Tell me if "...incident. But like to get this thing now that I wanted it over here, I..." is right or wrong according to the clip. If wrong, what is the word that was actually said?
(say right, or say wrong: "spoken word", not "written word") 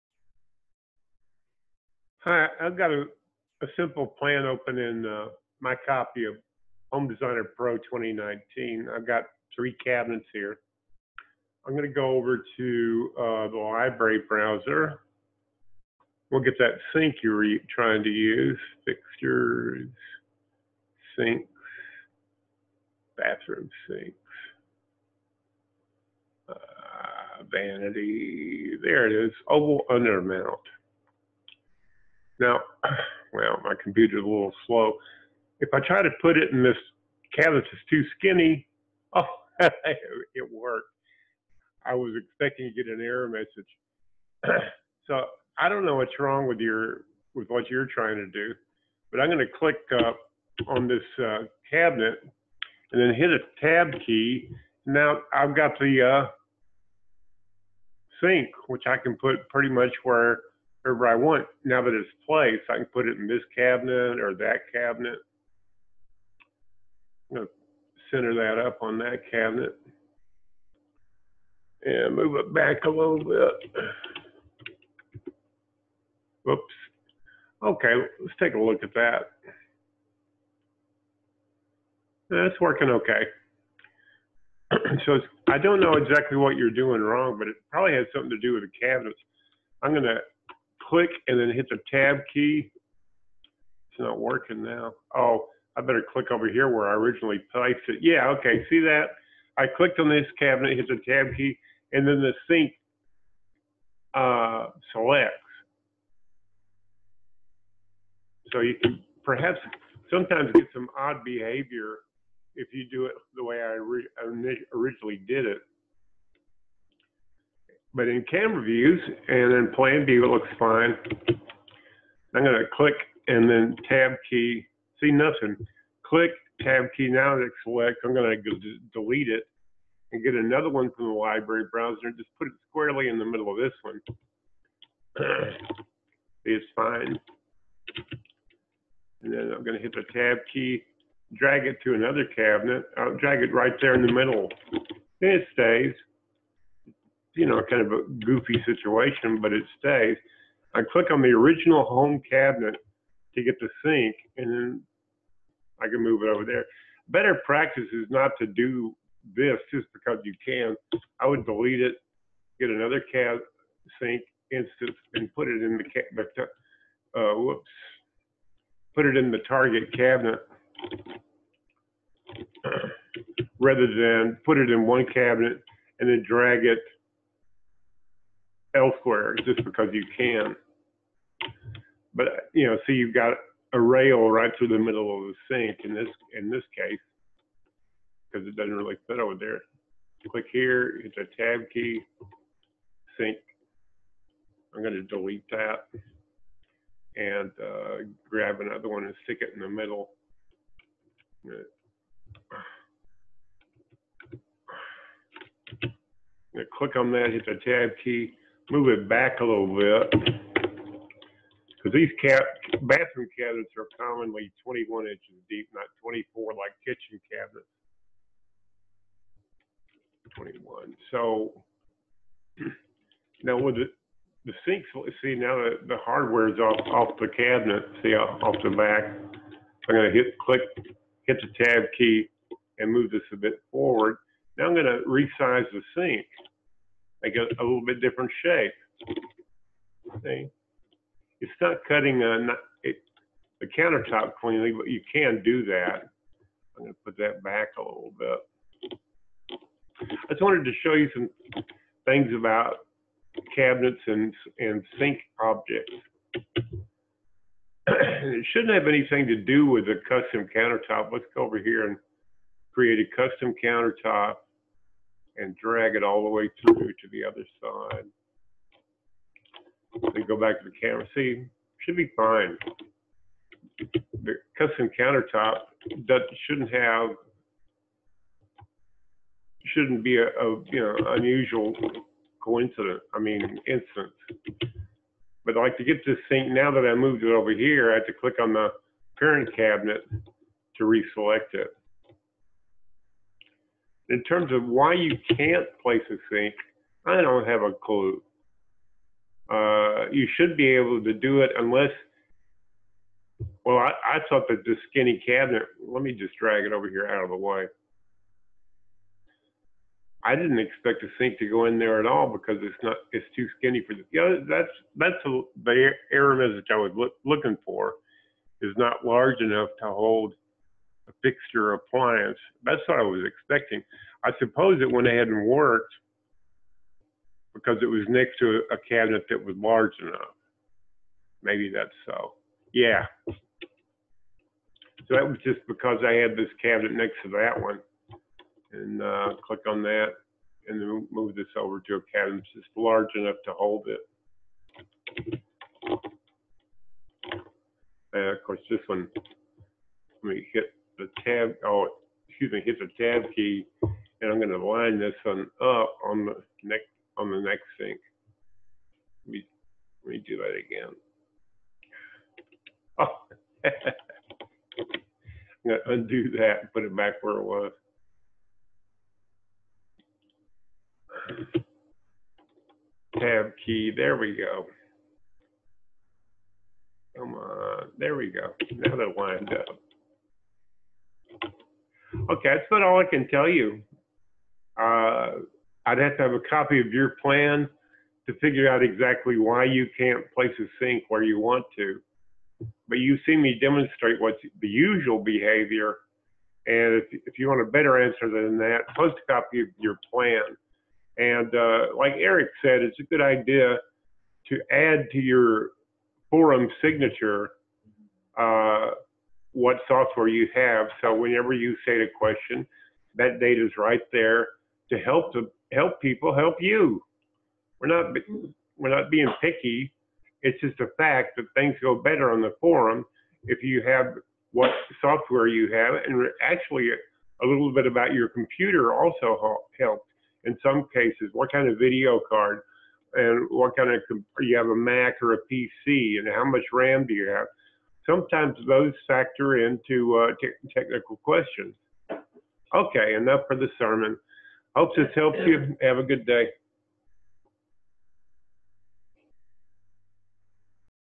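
wrong: "moved", not "wanted".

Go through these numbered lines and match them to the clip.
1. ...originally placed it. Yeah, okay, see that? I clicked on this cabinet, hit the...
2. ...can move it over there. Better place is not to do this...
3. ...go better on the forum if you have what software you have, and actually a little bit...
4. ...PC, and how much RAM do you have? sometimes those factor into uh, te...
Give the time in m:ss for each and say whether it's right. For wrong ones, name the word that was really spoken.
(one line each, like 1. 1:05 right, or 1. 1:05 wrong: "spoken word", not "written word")
1. 1:36 right
2. 2:35 wrong: "practice", not "place"
3. 7:01 right
4. 7:15 right.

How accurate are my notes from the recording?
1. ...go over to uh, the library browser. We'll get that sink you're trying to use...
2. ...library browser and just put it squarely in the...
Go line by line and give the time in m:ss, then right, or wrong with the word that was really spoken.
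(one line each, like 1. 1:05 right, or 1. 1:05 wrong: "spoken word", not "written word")
1. 0:11 right
2. 2:11 right.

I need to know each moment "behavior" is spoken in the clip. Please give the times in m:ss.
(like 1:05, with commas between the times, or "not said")
1:51, 6:35.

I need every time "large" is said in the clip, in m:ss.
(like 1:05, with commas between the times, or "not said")
5:19, 5:29, 5:42.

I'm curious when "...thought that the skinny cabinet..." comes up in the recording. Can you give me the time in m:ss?
5:04.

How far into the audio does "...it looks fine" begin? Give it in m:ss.
2:00.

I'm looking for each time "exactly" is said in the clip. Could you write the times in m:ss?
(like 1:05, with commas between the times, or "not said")
1:25, 6:28.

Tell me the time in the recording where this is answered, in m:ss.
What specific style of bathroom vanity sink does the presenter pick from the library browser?
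0:29.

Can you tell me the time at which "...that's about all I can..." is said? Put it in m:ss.
6:22.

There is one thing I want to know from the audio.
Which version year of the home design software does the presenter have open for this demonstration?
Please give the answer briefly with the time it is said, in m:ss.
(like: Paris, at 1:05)
2019, at 0:06.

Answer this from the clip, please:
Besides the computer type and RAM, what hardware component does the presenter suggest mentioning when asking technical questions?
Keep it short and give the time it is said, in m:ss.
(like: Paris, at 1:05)
Video card, at 7:11.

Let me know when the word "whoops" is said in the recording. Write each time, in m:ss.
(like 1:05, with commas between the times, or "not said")
1:16, 2:47.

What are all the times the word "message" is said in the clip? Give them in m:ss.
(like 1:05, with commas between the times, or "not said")
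0:43, 5:16.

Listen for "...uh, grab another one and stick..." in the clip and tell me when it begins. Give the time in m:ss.
3:17.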